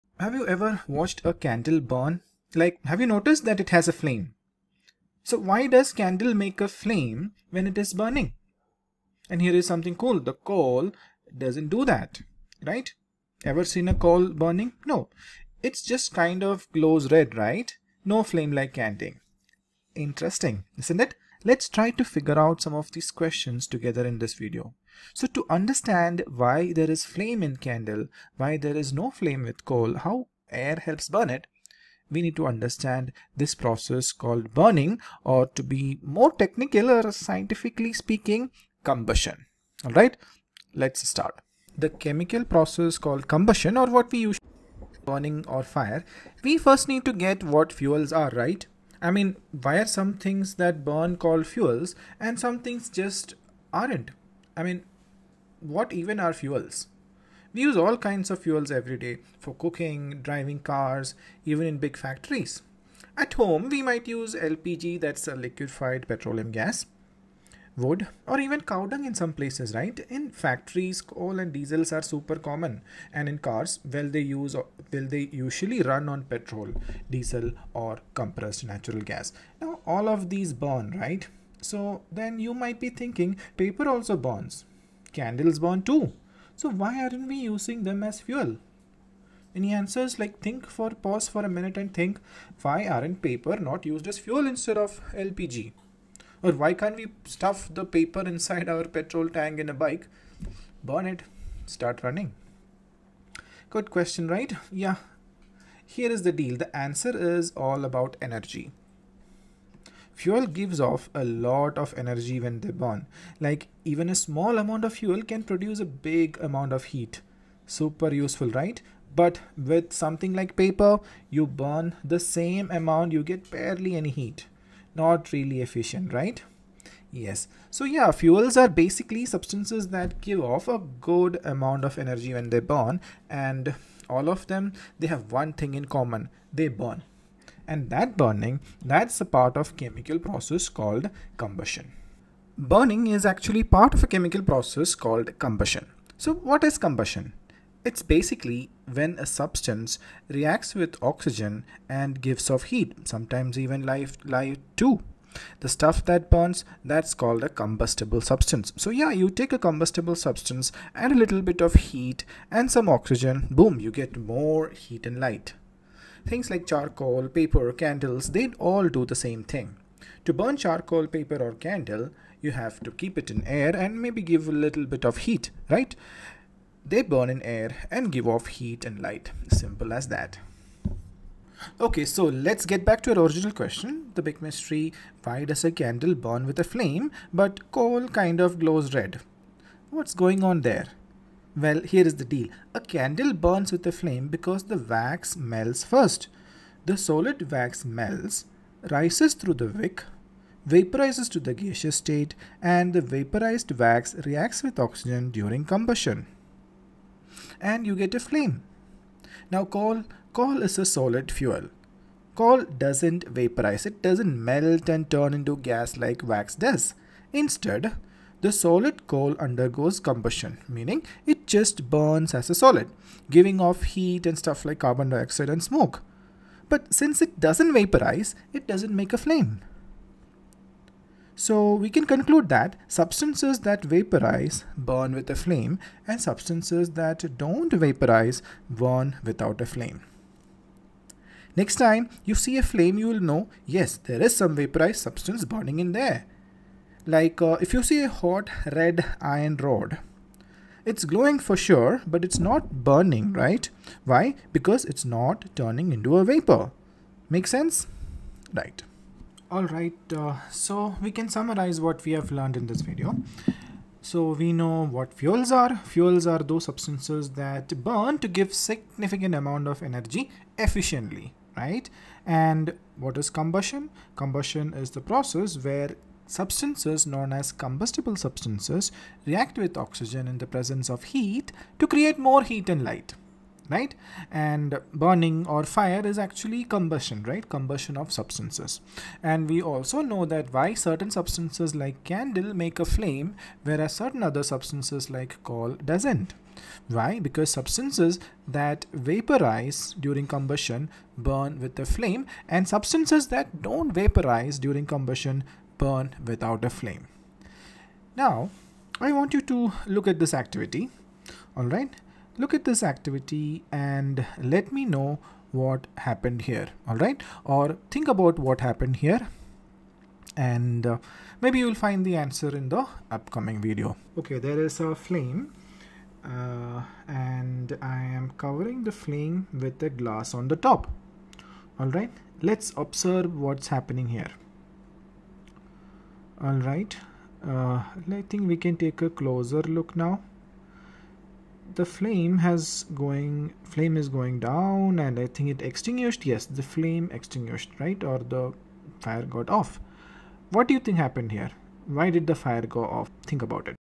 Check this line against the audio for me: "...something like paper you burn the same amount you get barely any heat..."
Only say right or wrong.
right.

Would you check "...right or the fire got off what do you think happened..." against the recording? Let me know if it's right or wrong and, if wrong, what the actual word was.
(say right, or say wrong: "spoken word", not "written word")
right.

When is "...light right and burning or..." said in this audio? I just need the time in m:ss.
4:42.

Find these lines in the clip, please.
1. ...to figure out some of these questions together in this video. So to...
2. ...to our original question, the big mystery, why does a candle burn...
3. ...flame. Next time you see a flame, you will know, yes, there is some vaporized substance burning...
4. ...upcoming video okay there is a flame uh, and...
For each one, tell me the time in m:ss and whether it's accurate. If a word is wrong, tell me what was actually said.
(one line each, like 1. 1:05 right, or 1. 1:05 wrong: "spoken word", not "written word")
1. 0:21 right
2. 3:03 right
3. 3:59 right
4. 5:23 right.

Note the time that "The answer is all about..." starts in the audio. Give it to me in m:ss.
1:46.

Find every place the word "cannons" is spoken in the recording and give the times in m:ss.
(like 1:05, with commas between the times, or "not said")
not said.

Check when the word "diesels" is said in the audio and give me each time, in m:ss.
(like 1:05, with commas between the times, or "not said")
1:11, 1:17.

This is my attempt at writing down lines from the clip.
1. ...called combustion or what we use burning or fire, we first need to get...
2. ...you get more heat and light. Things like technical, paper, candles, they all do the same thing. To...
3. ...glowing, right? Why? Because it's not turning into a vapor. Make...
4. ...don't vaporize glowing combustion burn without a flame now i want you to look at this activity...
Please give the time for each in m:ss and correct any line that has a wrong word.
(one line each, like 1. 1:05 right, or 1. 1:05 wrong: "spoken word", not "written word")
1. 0:42 right
2. 2:43 wrong: "charcoal", not "technical"
3. 4:12 wrong: "burning", not "glowing"
4. 5:03 wrong: "during", not "glowing".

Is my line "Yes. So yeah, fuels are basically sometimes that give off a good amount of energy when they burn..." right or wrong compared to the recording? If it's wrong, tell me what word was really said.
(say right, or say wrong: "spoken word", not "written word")
wrong: "substances", not "sometimes".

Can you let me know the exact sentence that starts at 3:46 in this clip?
But since it doesn't vaporize, it doesn't make a flame.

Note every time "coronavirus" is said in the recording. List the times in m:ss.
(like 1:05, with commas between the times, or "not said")
not said.